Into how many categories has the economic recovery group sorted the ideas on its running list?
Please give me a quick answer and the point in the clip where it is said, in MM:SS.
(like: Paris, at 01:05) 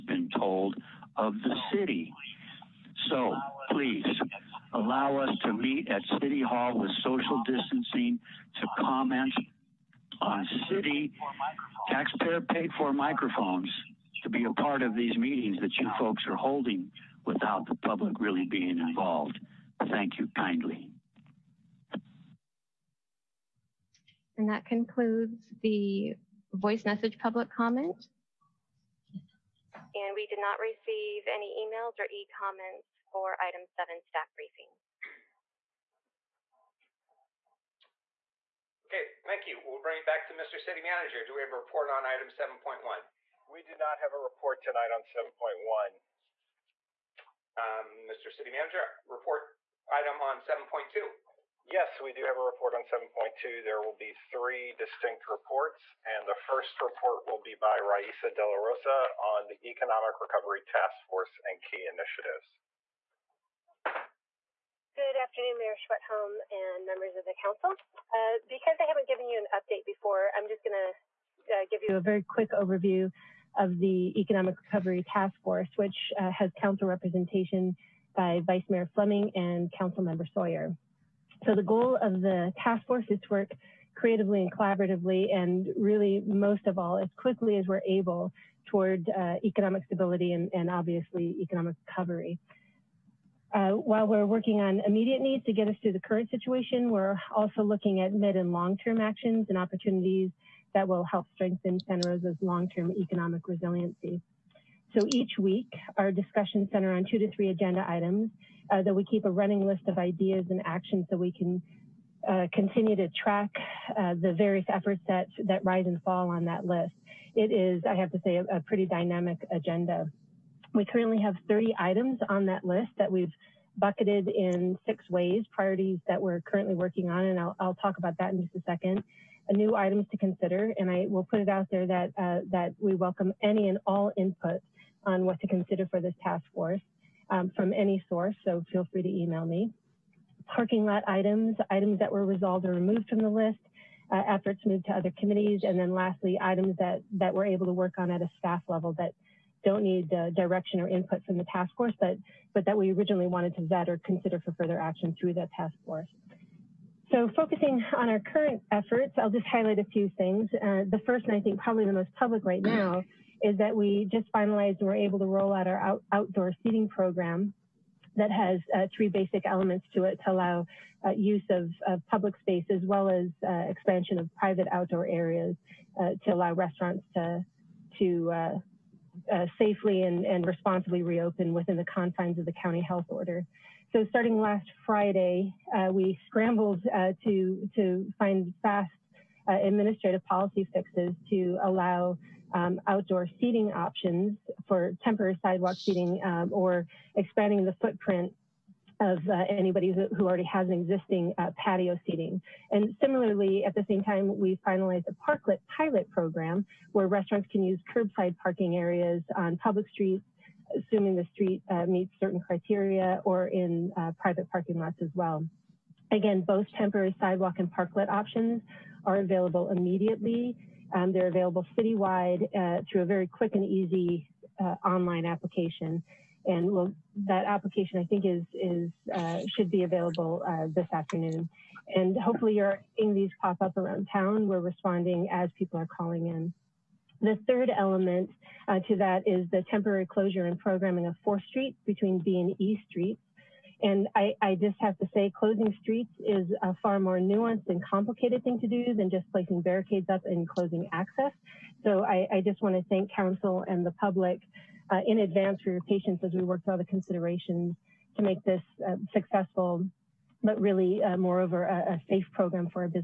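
6, at 02:04.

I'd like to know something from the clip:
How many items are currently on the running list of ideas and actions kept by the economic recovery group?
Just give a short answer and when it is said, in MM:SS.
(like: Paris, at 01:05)
30, at 02:01.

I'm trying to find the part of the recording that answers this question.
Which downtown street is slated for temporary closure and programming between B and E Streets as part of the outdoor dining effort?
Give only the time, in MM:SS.
04:01.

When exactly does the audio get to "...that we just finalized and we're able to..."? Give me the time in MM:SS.
02:43.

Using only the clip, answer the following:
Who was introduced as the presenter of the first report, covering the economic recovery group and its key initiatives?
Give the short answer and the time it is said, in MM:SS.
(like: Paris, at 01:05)
Raisa De La Rosa, at 00:57.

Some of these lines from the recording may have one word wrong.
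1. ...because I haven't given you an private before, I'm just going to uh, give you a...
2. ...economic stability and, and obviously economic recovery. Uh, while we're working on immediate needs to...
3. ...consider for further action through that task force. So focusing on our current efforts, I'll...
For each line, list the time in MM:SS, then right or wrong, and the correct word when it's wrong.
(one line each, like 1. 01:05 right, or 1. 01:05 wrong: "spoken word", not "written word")
1. 01:08 wrong: "update", not "private"
2. 01:29 right
3. 02:34 right.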